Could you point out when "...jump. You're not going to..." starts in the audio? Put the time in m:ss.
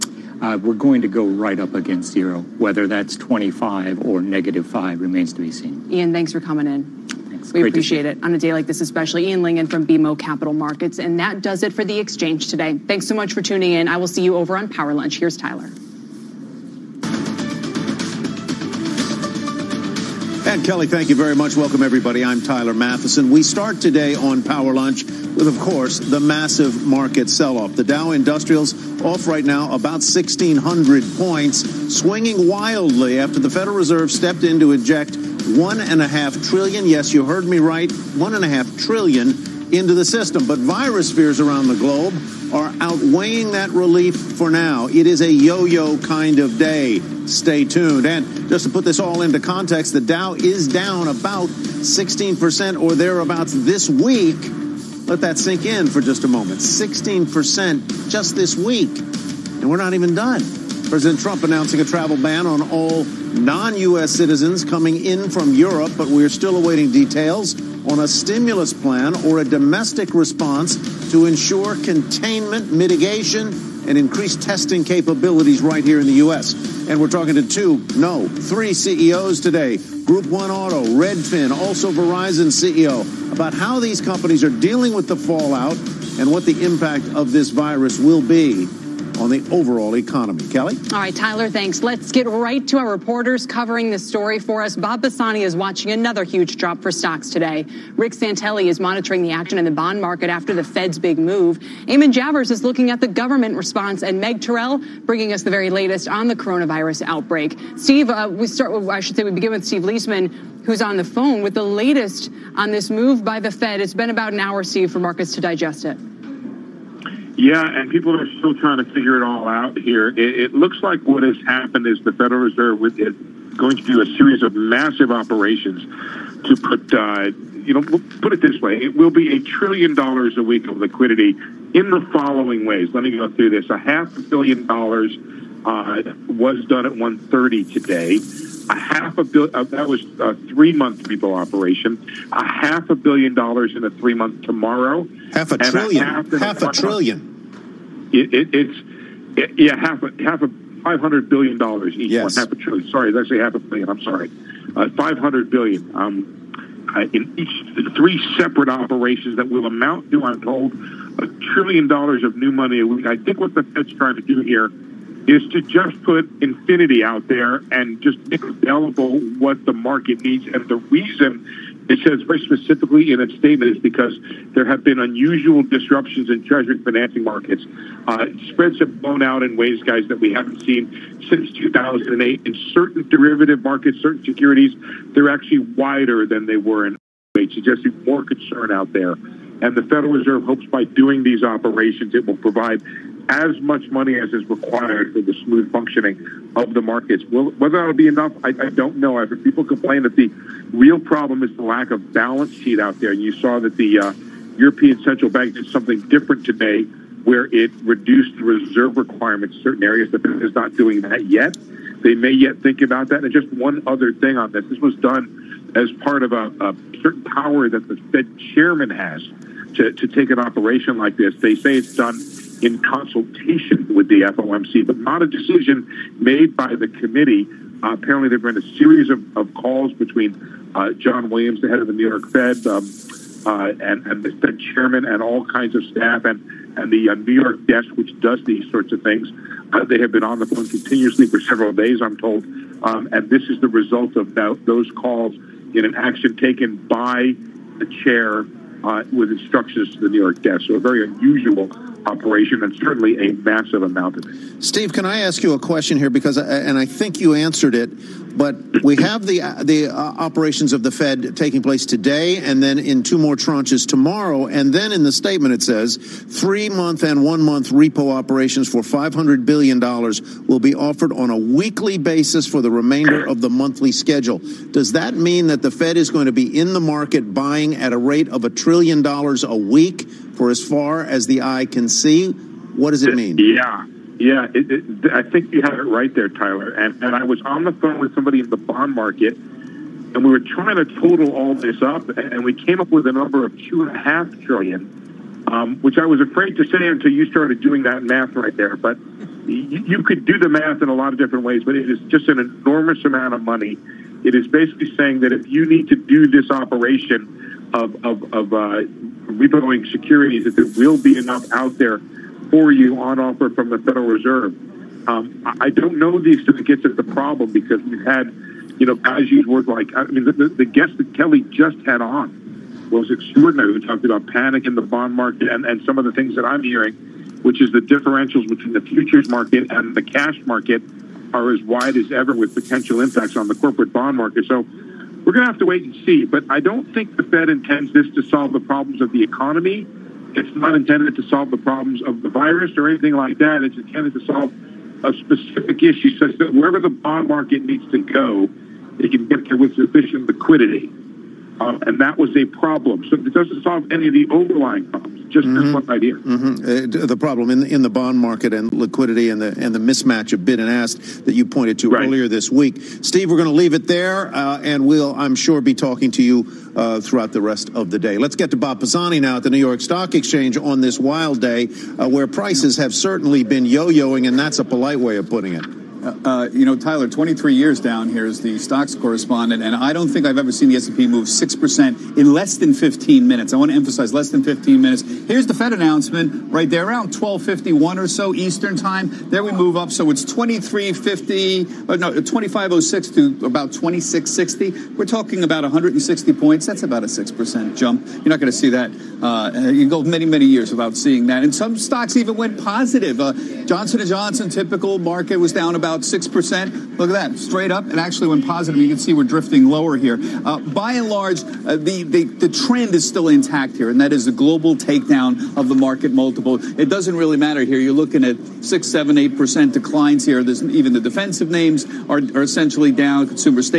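6:37.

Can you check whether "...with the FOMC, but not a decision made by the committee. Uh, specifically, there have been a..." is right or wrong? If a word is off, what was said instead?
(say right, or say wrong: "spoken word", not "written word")
wrong: "apparently", not "specifically".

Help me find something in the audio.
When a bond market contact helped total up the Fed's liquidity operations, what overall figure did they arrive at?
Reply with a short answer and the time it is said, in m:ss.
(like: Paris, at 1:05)
2.5 trillion, at 4:53.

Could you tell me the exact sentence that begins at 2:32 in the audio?
Sorry, that's actually half a billion.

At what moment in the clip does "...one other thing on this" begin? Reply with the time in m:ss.
3:33.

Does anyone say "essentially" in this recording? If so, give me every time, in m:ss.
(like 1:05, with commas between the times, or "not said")
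7:02.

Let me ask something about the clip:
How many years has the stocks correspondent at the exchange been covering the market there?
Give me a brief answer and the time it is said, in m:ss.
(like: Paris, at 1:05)
23 years, at 6:17.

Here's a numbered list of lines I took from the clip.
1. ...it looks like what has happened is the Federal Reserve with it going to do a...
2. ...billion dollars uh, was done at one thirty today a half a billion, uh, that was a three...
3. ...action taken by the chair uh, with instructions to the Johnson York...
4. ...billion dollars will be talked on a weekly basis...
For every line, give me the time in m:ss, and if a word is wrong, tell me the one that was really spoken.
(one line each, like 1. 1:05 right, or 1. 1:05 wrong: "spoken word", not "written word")
1. 2:00 right
2. 2:14 right
3. 4:05 wrong: "New", not "Johnson"
4. 4:29 wrong: "offered", not "talked".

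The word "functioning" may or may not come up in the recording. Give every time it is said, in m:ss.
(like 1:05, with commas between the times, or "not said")
3:15.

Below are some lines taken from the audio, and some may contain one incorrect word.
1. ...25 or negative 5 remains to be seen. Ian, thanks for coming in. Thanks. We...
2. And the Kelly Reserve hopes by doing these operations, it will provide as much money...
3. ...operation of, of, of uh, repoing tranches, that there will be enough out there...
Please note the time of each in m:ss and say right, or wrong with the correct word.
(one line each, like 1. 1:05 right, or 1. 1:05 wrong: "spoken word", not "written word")
1. 0:03 right
2. 3:09 wrong: "Federal", not "Kelly"
3. 5:06 wrong: "securities", not "tranches".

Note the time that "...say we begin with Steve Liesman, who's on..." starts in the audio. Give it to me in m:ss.
1:49.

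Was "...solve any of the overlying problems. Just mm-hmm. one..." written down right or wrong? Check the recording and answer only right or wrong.
right.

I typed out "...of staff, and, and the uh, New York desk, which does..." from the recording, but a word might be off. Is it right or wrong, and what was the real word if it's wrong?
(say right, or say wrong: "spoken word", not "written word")
right.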